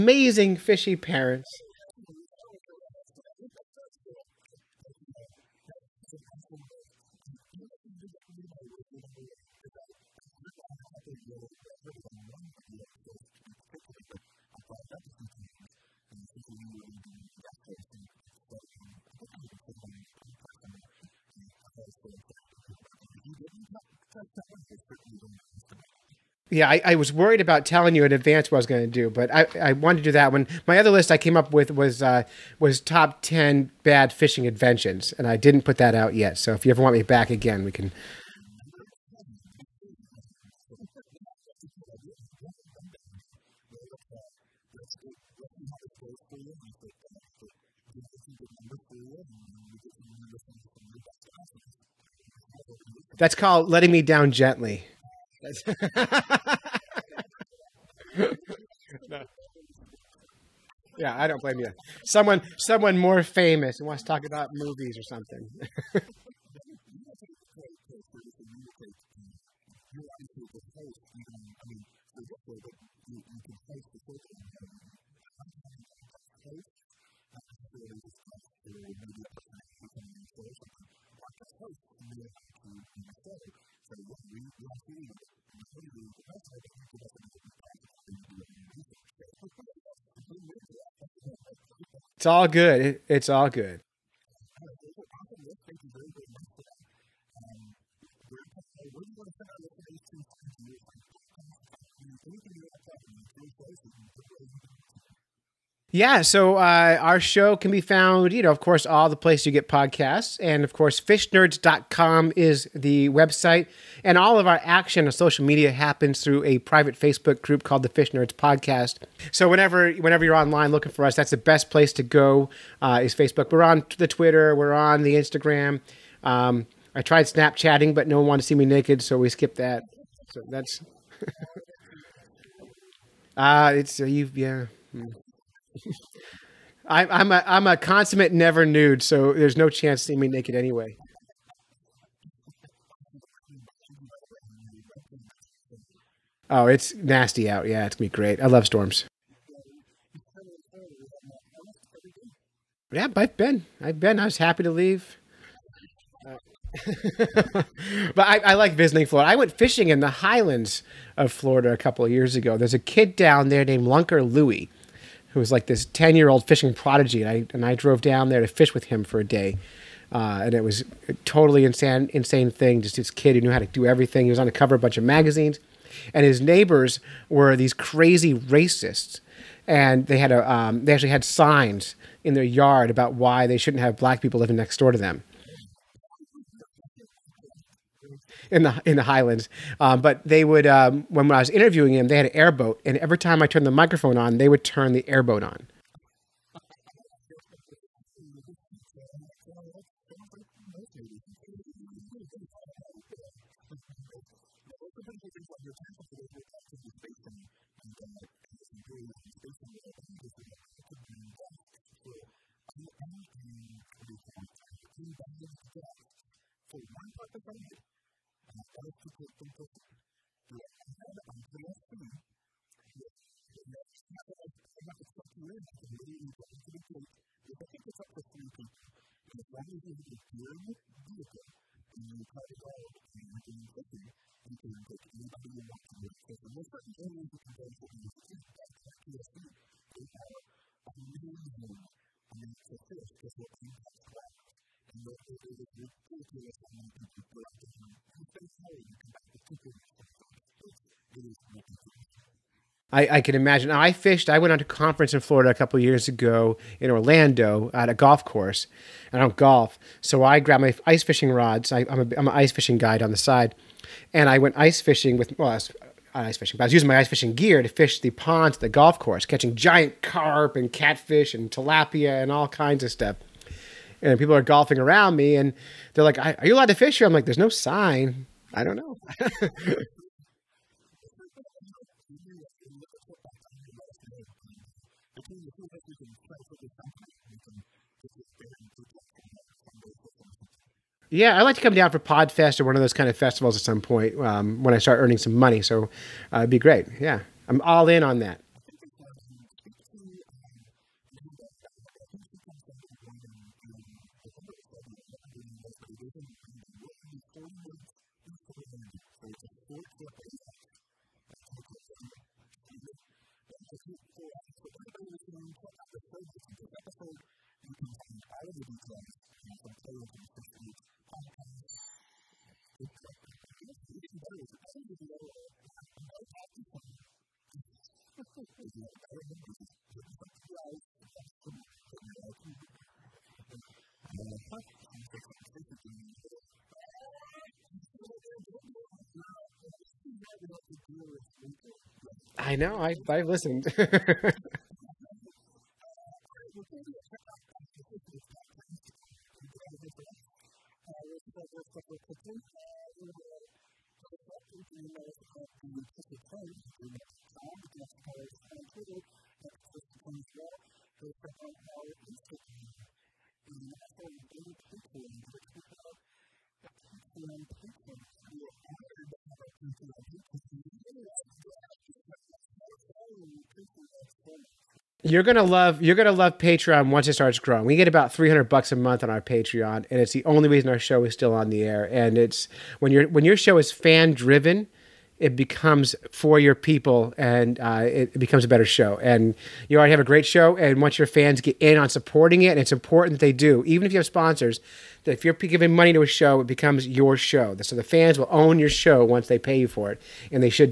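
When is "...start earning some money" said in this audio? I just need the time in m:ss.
4:54.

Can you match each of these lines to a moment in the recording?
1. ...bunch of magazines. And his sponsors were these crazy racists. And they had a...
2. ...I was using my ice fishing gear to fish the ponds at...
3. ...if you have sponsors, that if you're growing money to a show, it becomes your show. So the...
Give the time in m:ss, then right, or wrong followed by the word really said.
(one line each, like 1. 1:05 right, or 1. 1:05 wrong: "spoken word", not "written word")
1. 2:54 wrong: "neighbors", not "sponsors"
2. 4:26 right
3. 6:33 wrong: "giving", not "growing".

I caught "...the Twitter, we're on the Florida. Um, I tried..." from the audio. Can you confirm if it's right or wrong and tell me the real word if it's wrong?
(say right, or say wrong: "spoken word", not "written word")
wrong: "Instagram", not "Florida".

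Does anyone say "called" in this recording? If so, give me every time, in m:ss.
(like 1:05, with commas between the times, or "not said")
0:53, 1:57.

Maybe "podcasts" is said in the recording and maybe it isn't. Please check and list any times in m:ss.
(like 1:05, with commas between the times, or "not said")
1:49, 1:58.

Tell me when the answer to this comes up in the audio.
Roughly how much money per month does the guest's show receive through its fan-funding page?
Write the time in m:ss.
6:18.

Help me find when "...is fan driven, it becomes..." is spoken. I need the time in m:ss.
6:23.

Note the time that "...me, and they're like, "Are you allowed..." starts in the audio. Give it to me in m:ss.
4:35.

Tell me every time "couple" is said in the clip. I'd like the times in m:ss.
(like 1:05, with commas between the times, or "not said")
2:41, 4:15.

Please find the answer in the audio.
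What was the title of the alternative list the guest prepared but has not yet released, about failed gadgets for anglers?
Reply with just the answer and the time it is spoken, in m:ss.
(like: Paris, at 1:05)
Top ten bad fishing inventions, at 0:32.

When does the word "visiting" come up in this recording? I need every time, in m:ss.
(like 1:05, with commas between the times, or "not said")
2:38.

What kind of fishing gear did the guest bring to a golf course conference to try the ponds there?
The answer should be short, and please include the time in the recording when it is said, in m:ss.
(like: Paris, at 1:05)
Ice fishing rods, at 4:20.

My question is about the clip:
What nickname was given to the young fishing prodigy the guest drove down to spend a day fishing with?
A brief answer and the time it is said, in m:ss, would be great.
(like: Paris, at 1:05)
Lunker Louie, at 2:43.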